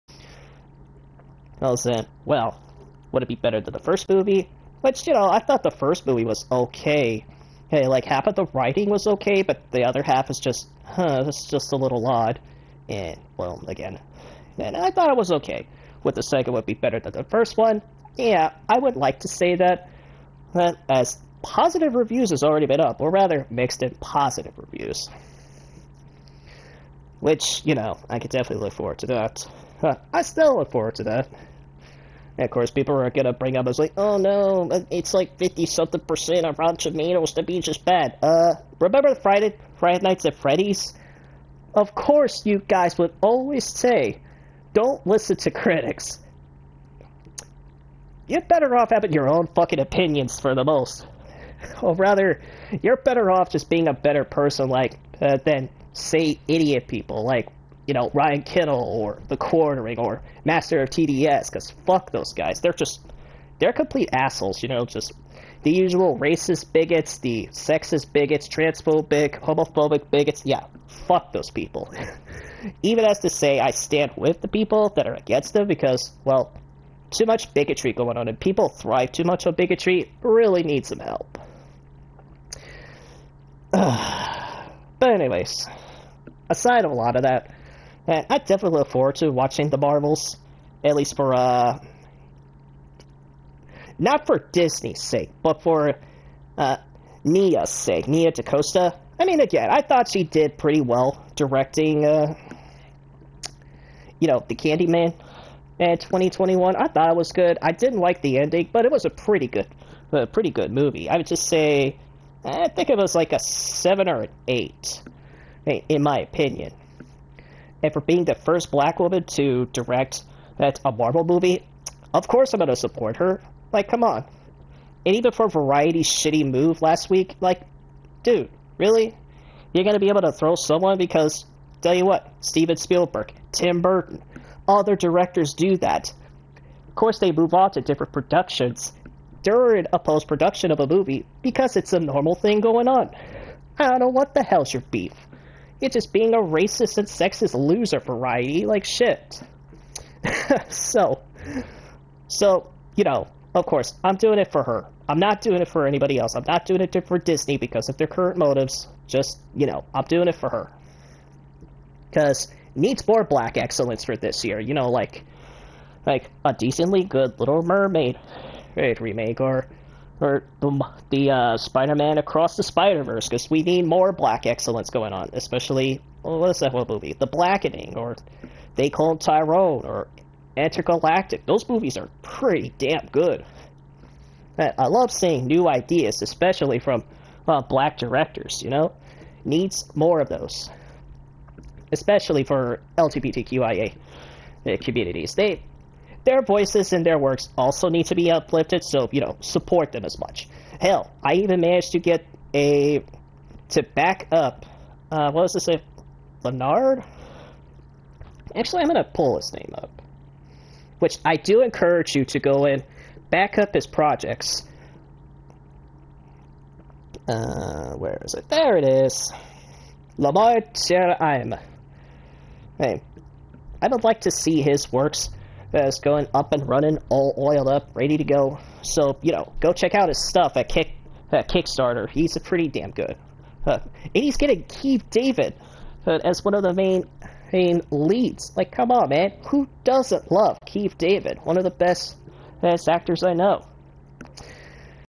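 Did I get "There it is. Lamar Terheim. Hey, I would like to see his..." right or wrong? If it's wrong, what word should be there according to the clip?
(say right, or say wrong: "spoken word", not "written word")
right.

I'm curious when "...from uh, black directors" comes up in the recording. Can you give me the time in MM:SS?
03:06.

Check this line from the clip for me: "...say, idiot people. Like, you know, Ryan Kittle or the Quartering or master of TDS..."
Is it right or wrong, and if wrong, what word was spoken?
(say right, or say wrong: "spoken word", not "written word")
right.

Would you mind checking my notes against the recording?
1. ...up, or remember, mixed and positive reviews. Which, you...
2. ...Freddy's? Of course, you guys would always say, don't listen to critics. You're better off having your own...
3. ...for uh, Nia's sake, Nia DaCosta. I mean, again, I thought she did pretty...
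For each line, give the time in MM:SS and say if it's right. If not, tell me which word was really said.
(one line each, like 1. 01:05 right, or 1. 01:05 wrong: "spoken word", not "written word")
1. 00:22 wrong: "rather", not "remember"
2. 00:40 right
3. 01:35 right.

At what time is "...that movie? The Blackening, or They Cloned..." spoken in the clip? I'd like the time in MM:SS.
02:56.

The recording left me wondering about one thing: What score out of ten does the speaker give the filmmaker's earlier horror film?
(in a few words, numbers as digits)
7 or 8.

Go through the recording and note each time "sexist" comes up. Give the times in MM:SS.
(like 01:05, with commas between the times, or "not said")
01:07, 02:27.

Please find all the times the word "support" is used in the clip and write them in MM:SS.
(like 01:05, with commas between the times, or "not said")
02:02, 03:19.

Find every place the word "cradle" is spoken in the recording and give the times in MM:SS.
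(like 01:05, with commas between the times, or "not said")
not said.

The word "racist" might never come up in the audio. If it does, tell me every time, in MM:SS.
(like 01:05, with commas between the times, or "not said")
01:06, 02:26.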